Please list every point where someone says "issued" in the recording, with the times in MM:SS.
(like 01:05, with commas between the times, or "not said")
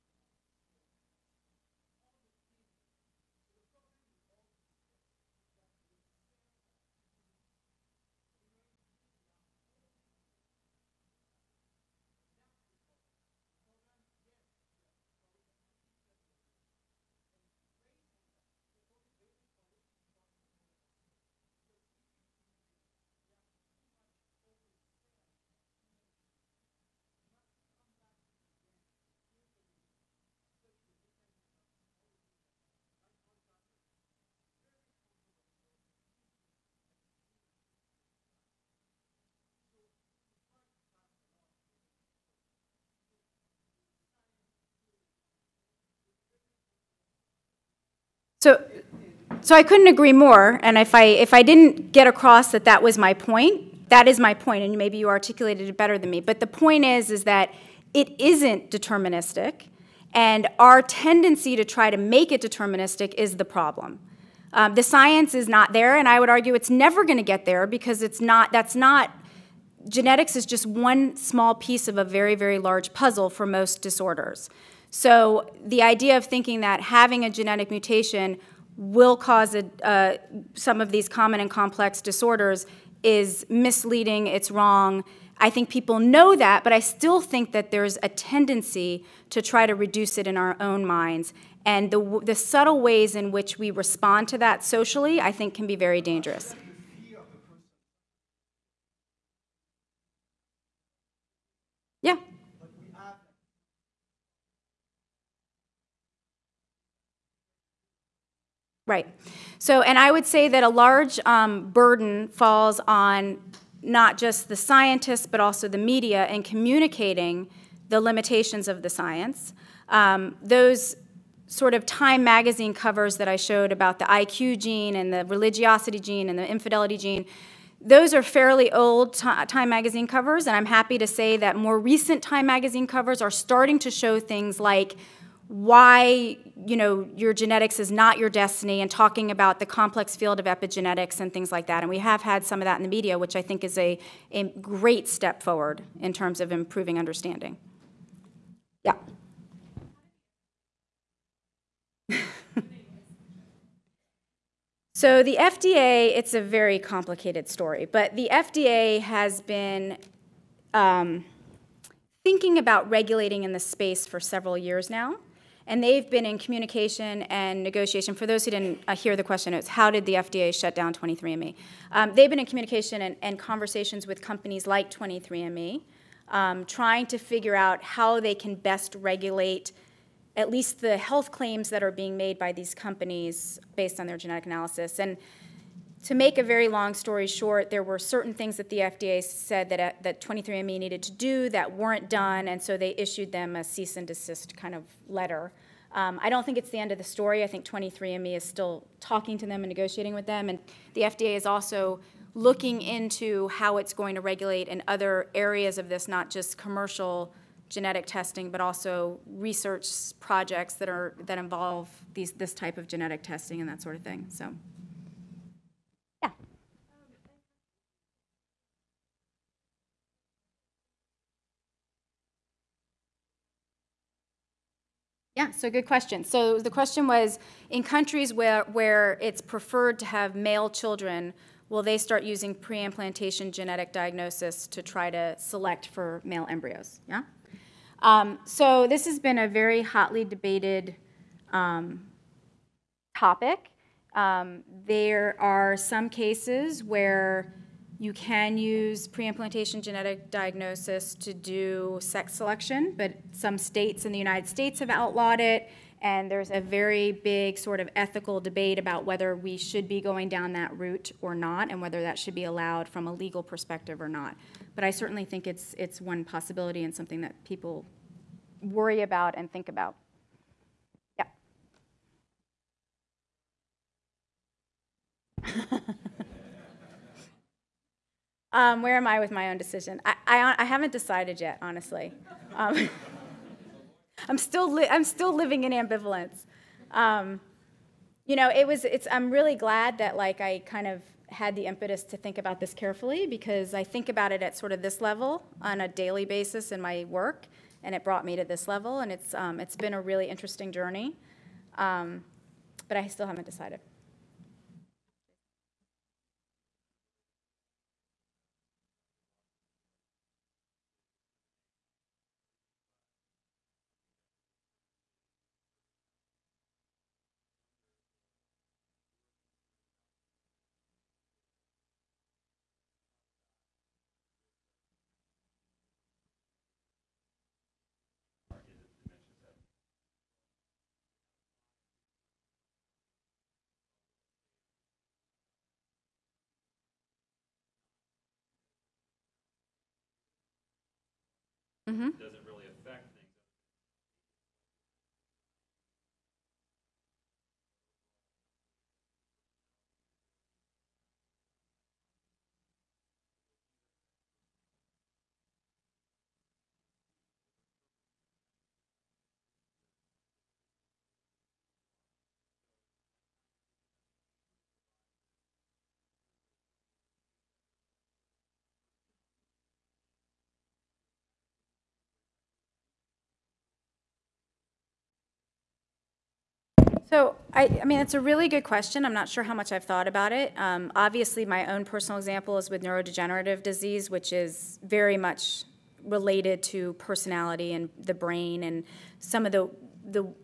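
03:12.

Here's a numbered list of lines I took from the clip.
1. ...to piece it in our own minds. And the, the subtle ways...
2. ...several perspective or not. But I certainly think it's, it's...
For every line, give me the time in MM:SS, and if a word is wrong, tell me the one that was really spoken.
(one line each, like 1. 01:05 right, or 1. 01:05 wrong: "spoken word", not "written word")
1. 01:29 wrong: "reduce", not "piece"
2. 04:23 wrong: "legal", not "several".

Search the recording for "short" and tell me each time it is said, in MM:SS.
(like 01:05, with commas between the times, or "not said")
03:07.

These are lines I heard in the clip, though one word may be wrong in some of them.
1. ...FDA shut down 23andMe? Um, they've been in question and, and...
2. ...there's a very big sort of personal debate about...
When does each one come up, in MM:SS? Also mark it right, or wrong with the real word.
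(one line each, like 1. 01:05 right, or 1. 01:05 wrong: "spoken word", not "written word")
1. 02:50 wrong: "communication", not "question"
2. 04:16 wrong: "ethical", not "personal".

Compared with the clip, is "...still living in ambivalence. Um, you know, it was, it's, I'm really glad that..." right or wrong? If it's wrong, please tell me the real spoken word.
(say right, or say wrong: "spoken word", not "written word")
right.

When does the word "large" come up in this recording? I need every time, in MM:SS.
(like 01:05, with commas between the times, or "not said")
01:12, 01:50.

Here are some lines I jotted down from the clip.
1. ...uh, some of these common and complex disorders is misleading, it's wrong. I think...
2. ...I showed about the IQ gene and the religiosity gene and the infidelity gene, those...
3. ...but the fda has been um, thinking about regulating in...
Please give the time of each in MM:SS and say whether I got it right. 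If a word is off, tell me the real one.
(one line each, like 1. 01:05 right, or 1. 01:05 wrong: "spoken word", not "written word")
1. 01:19 right
2. 02:03 right
3. 02:37 right.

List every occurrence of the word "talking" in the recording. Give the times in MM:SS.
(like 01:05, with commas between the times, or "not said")
02:18, 03:18.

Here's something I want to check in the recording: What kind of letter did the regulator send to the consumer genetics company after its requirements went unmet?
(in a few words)
cease and desist.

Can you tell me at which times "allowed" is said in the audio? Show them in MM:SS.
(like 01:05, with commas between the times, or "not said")
04:22.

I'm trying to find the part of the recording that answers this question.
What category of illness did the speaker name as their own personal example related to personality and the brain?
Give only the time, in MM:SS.
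06:22.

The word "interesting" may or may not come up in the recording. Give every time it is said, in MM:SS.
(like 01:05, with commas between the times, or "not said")
05:00.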